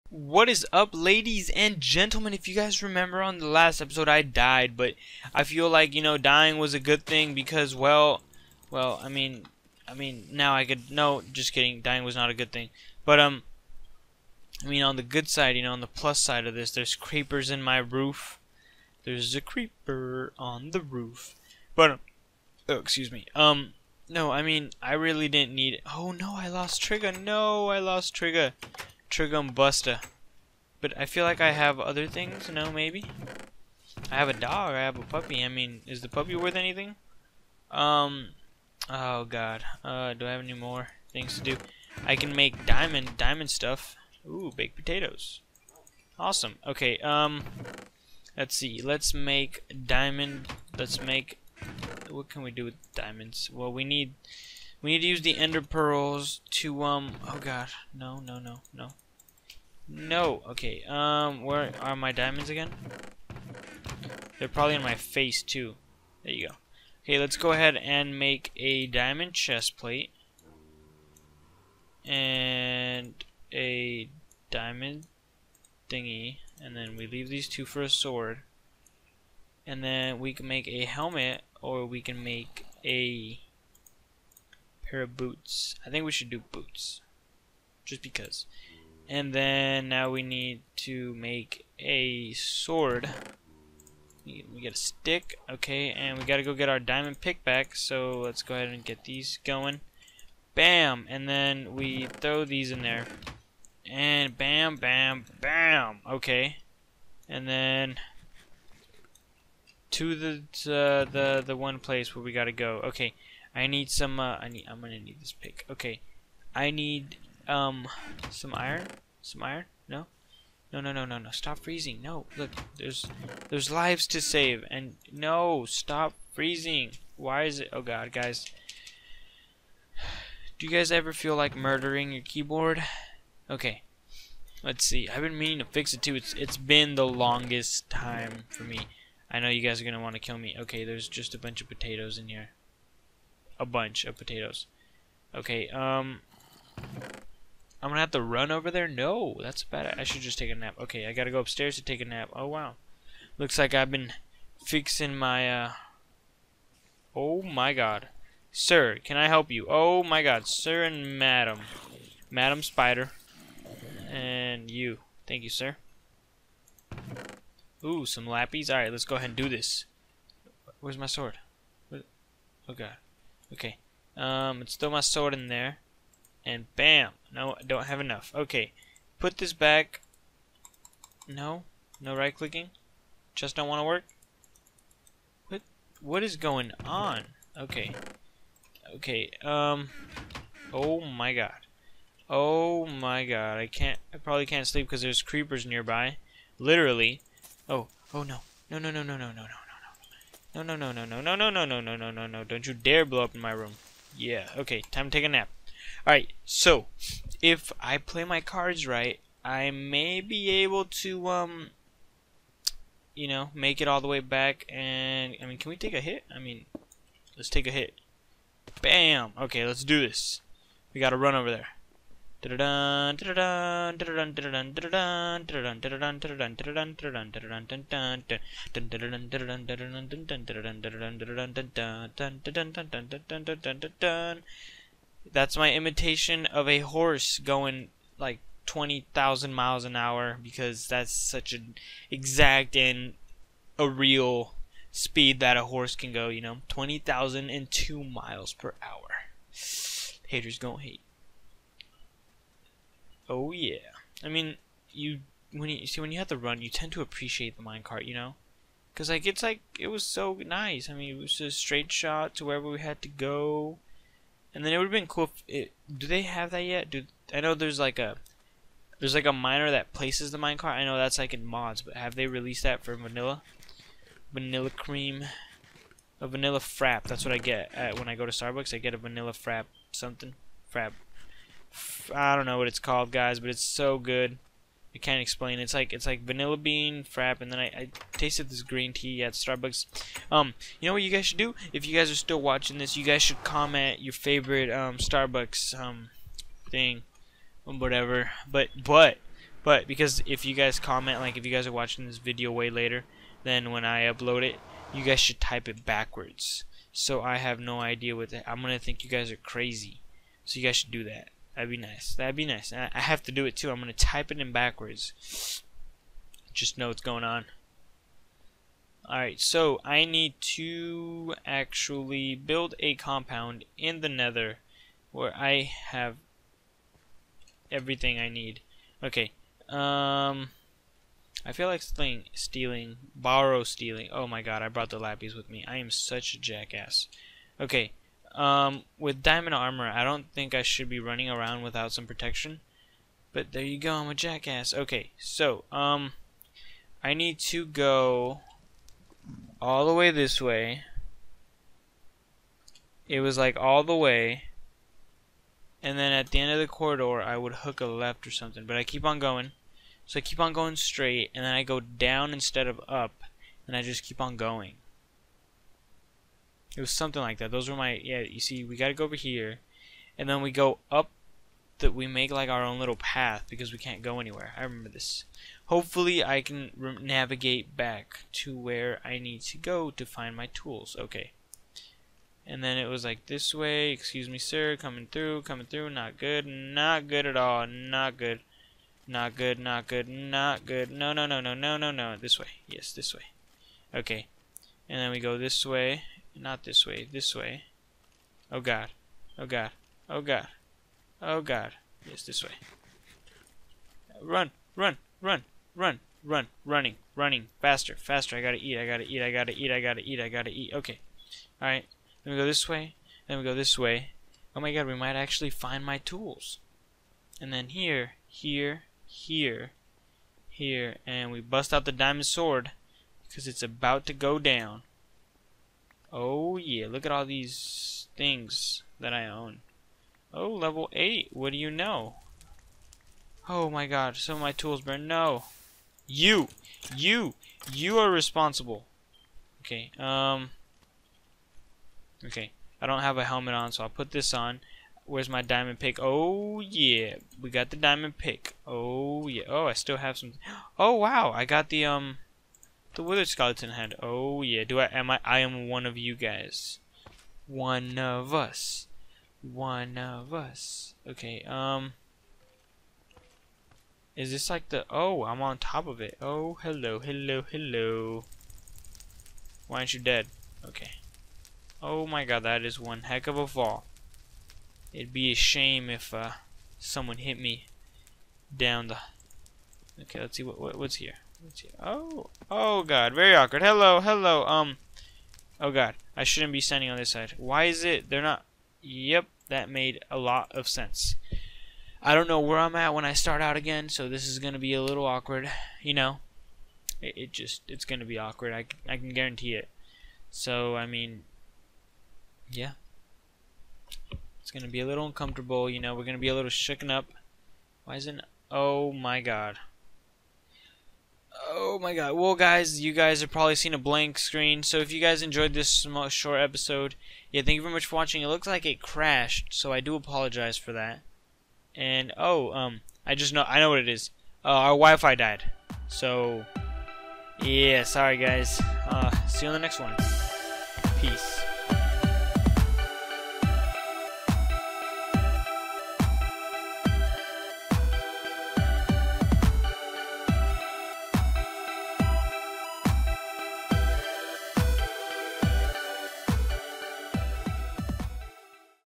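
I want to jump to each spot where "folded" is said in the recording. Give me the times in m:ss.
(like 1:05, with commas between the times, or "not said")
not said.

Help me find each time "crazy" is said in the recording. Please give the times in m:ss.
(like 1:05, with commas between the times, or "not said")
5:09.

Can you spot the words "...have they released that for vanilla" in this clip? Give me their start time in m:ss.
4:31.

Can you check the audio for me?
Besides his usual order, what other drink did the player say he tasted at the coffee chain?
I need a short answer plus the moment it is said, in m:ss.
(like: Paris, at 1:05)
green tea, at 4:48.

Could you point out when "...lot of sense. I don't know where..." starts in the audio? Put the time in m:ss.
8:10.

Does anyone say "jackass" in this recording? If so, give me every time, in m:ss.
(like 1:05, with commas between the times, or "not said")
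5:36, 5:44.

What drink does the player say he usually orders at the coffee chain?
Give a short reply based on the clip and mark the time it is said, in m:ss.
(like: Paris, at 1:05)
vanilla bean frap, at 4:46.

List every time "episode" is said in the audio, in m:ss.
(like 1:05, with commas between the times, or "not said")
0:03, 8:36.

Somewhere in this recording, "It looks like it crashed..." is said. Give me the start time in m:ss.
8:38.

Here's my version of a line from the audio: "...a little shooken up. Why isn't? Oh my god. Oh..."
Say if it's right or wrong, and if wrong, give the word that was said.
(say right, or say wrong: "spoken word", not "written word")
right.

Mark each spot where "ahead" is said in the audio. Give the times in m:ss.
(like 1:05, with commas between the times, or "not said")
1:07, 1:38, 2:49.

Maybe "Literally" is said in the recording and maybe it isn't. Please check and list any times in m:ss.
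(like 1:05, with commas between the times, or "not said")
3:16.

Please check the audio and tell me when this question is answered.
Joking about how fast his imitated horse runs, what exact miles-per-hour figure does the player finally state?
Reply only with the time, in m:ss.
4:06.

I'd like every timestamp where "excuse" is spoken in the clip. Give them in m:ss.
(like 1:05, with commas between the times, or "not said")
0:22, 6:23.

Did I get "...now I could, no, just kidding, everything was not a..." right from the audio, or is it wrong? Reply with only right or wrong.
wrong.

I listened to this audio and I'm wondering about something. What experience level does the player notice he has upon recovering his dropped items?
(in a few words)
8.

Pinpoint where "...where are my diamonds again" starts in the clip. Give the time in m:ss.
1:01.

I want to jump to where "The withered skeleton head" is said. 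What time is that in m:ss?
7:32.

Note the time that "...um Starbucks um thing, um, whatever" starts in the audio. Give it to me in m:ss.
4:54.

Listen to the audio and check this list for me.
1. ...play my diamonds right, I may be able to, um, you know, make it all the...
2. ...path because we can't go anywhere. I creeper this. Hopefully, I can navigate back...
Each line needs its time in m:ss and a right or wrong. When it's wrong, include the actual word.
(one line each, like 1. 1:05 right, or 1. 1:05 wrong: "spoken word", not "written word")
1. 3:27 wrong: "cards", not "diamonds"
2. 6:12 wrong: "remember", not "creeper".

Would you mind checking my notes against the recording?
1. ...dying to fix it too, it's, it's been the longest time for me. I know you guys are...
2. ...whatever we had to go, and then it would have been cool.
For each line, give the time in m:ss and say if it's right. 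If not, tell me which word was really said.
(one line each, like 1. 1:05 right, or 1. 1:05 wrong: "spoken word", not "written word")
1. 2:15 wrong: "meaning", not "dying"
2. 4:22 wrong: "wherever", not "whatever".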